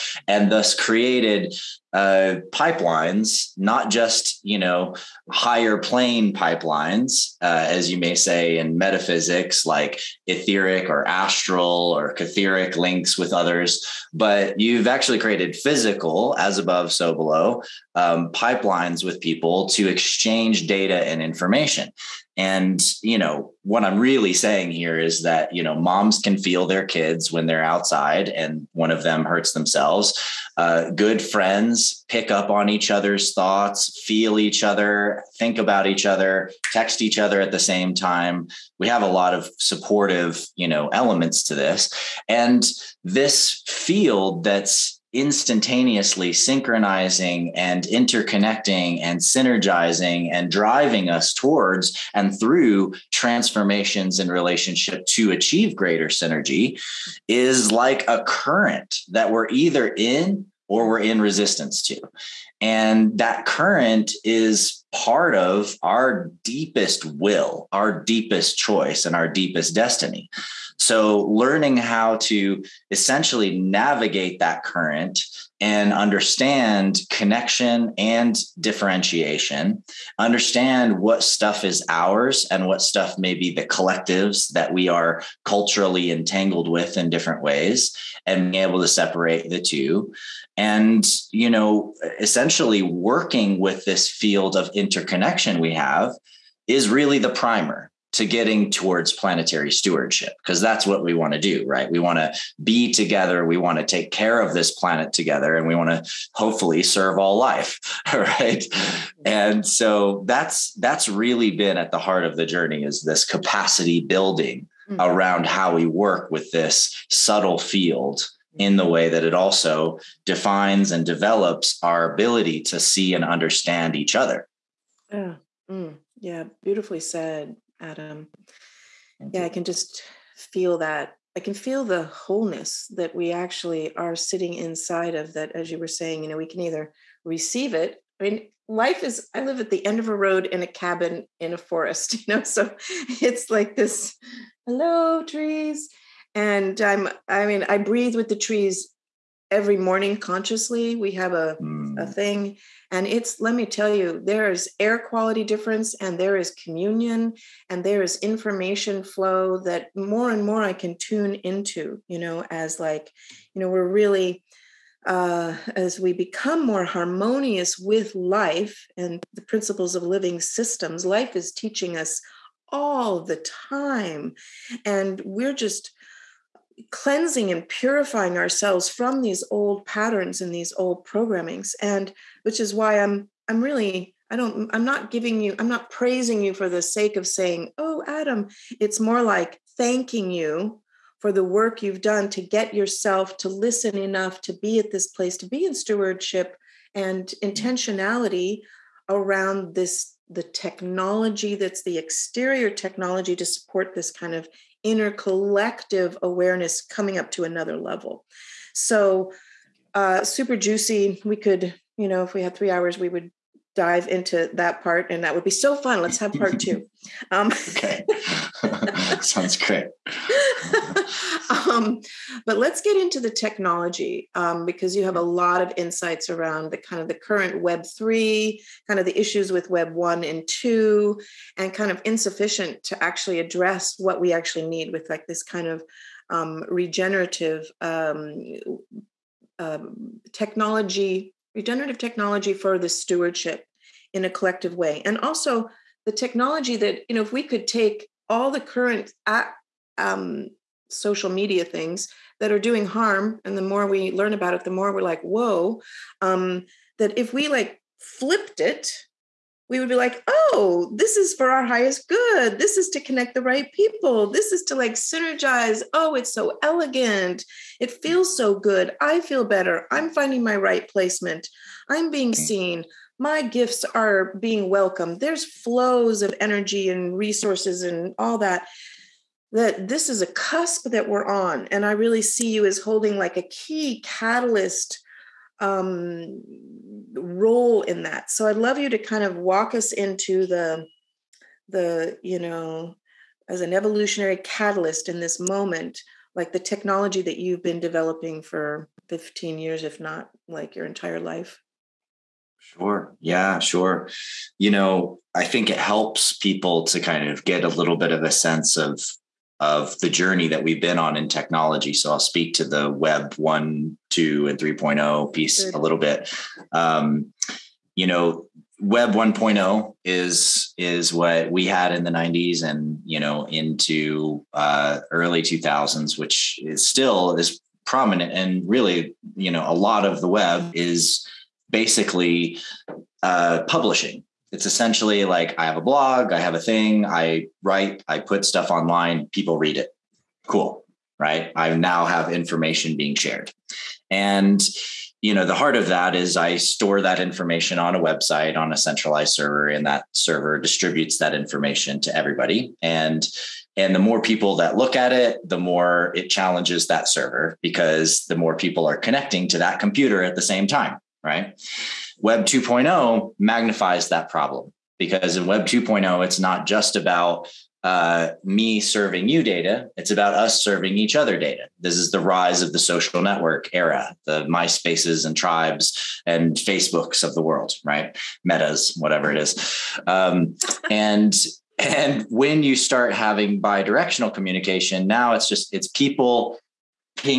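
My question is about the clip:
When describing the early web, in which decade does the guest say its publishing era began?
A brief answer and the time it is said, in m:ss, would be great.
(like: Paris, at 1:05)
the 90s, at 5:22.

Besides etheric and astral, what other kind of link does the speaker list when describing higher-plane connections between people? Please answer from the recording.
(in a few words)
catheric.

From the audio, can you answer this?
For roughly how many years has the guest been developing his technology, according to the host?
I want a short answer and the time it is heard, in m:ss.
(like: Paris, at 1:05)
15, at 4:59.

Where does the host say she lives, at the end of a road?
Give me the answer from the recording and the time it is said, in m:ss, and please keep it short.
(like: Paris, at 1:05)
a cabin in a forest, at 2:20.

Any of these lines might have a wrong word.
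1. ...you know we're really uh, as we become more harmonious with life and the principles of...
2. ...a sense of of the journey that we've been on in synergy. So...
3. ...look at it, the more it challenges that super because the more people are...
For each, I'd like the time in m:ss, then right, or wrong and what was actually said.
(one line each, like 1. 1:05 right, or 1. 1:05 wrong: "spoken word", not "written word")
1. 2:43 right
2. 5:08 wrong: "technology", not "synergy"
3. 5:54 wrong: "server", not "super".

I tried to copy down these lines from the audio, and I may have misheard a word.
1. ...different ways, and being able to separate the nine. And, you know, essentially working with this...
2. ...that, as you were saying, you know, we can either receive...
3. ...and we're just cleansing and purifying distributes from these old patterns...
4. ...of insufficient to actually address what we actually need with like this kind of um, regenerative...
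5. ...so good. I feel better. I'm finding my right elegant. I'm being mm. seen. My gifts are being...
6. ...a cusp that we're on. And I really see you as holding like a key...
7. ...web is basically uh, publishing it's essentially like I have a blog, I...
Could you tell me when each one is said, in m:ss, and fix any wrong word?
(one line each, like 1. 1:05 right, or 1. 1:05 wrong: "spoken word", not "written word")
1. 1:27 wrong: "two", not "nine"
2. 2:15 right
3. 2:54 wrong: "ourselves", not "distributes"
4. 3:51 right
5. 4:28 wrong: "placement", not "elegant"
6. 4:40 right
7. 5:30 right.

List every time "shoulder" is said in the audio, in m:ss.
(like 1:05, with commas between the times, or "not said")
not said.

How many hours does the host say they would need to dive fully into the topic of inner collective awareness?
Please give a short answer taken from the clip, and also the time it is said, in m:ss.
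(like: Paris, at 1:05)
3, at 3:32.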